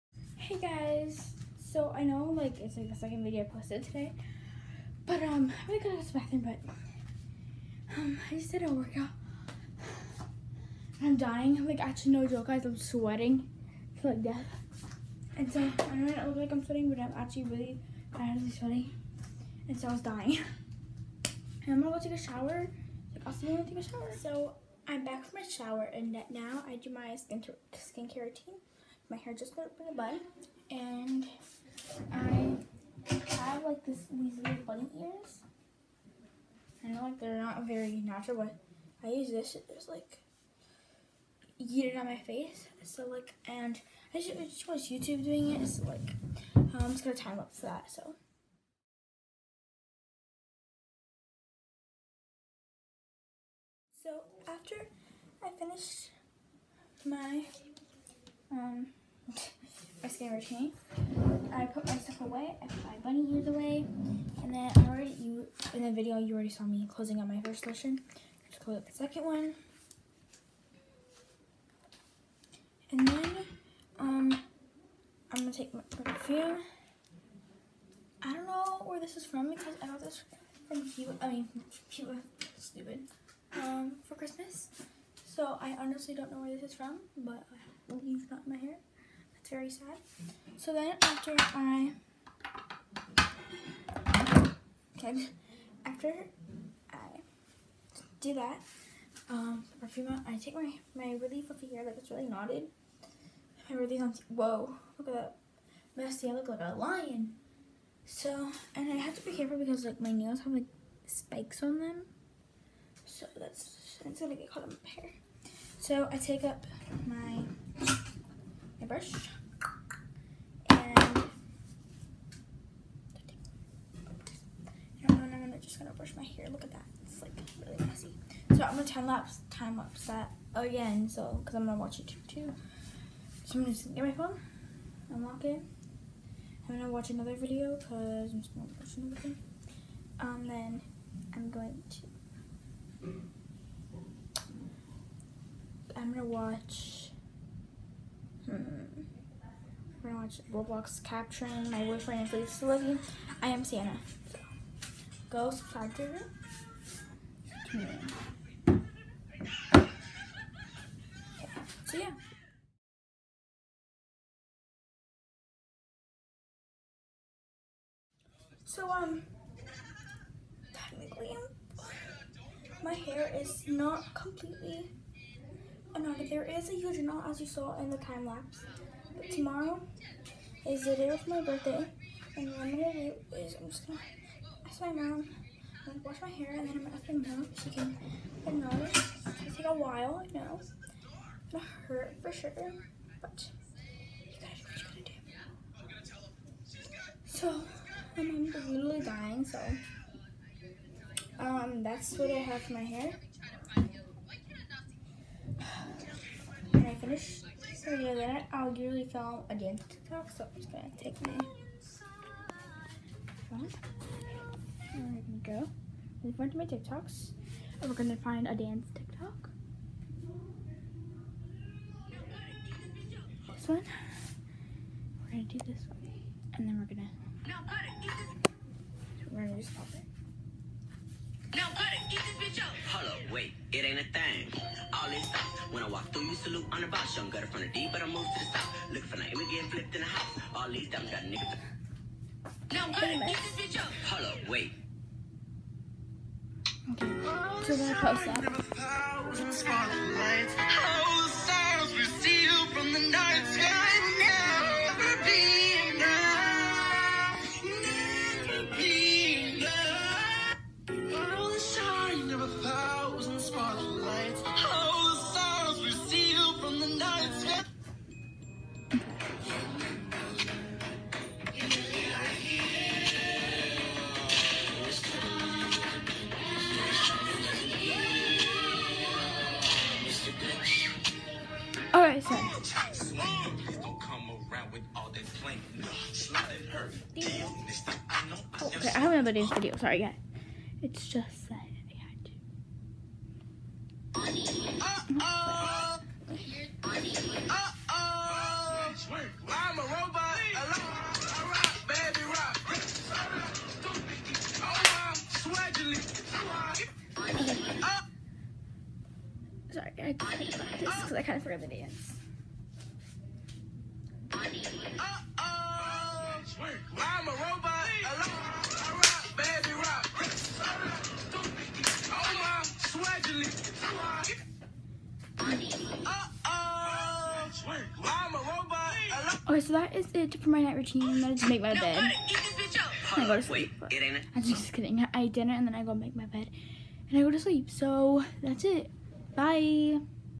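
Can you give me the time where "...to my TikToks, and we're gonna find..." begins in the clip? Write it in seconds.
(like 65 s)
216 s.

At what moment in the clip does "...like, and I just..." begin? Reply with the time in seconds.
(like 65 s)
43 s.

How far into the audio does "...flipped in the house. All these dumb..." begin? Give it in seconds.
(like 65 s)
239 s.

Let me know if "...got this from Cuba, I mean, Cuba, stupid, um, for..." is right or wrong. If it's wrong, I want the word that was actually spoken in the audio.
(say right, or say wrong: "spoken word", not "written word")
right.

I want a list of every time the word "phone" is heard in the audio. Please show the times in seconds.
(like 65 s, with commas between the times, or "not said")
134 s, 213 s.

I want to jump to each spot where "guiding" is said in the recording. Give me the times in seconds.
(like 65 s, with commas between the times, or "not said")
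not said.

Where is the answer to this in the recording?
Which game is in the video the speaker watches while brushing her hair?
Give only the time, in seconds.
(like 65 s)
150 s.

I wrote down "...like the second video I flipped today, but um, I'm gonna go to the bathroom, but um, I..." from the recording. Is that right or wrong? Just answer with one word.
wrong.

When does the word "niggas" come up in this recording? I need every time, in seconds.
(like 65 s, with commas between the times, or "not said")
241 s.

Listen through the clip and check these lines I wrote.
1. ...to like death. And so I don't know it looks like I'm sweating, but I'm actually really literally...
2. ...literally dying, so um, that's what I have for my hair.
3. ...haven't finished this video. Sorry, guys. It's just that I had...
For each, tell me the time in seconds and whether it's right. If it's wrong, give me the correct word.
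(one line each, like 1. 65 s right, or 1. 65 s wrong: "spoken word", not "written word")
1. 14 s wrong: "badly", not "literally"
2. 198 s right
3. 288 s wrong: "uploaded", not "finished".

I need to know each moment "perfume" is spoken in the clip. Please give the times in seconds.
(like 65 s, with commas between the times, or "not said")
76 s, 99 s.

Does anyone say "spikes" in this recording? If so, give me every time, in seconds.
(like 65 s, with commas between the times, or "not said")
111 s.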